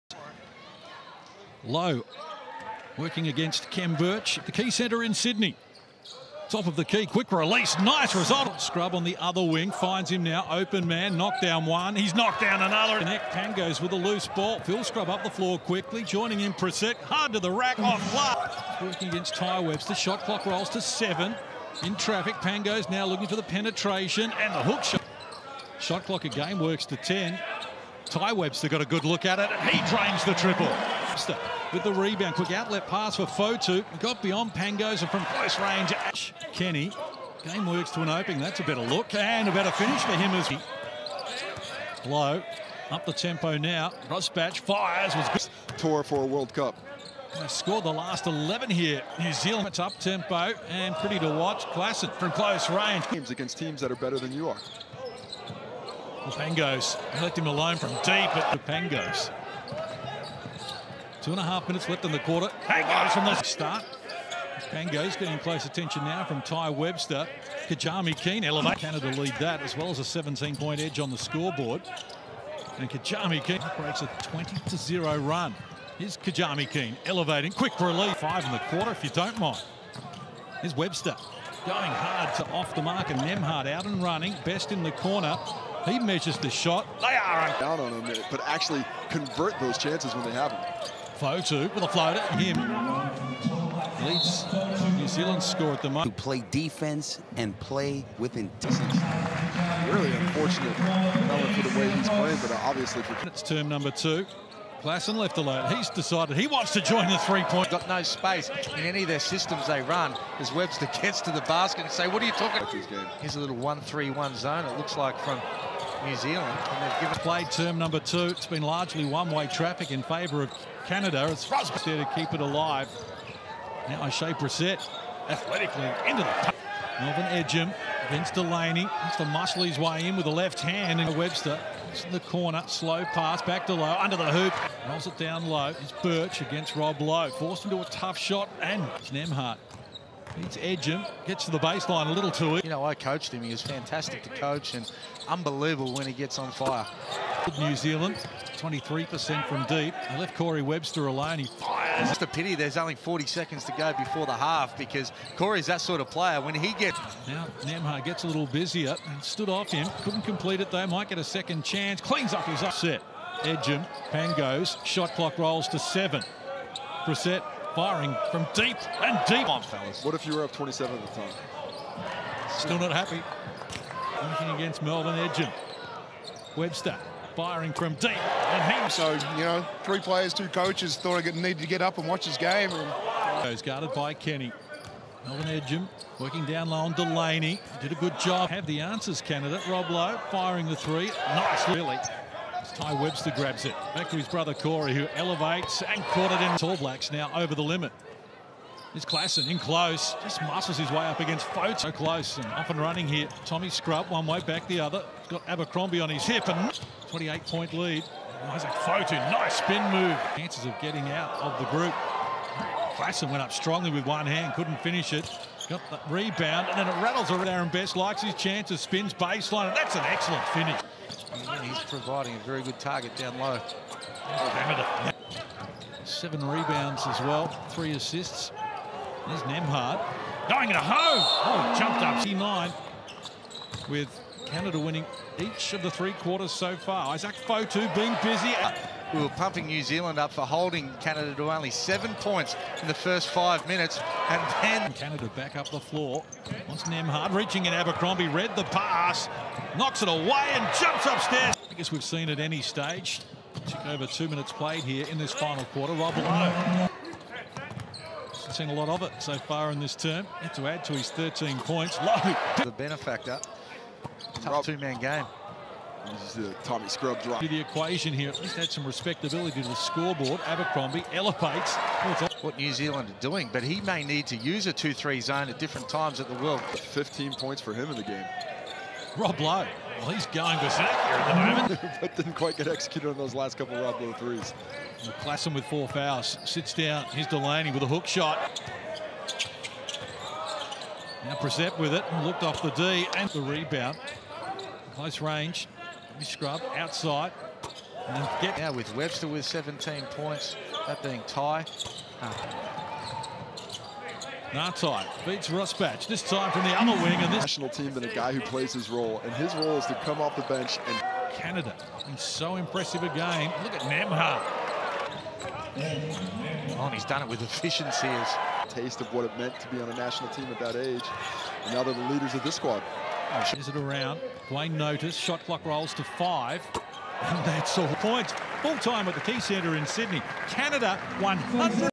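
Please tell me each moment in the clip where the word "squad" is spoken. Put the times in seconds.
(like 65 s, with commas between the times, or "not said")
322 s.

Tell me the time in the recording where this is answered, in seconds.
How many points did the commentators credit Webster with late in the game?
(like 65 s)
299 s.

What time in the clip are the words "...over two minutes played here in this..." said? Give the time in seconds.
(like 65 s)
253 s.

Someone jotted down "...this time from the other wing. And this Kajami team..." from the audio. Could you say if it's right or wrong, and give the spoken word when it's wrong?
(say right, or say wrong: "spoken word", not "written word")
wrong: "National", not "Kajami".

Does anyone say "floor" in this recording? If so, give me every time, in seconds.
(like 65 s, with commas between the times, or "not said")
15 s, 245 s.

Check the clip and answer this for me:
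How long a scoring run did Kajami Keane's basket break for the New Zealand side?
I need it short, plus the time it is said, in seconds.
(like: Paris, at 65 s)
20-0, at 74 s.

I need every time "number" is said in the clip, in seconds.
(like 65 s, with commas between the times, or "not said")
103 s, 117 s.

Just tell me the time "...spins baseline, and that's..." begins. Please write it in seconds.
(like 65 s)
218 s.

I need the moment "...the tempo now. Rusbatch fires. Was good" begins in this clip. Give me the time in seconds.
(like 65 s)
43 s.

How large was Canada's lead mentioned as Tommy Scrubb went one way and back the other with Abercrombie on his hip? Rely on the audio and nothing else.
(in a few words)
28 points.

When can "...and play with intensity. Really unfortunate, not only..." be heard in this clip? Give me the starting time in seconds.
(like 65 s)
97 s.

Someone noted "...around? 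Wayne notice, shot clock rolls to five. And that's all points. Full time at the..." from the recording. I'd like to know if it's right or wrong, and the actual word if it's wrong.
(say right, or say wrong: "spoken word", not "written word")
right.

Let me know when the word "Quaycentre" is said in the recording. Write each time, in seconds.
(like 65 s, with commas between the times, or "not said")
4 s, 329 s.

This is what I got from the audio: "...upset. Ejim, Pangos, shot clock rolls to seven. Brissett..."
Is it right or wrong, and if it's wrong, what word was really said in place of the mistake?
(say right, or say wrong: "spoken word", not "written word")
right.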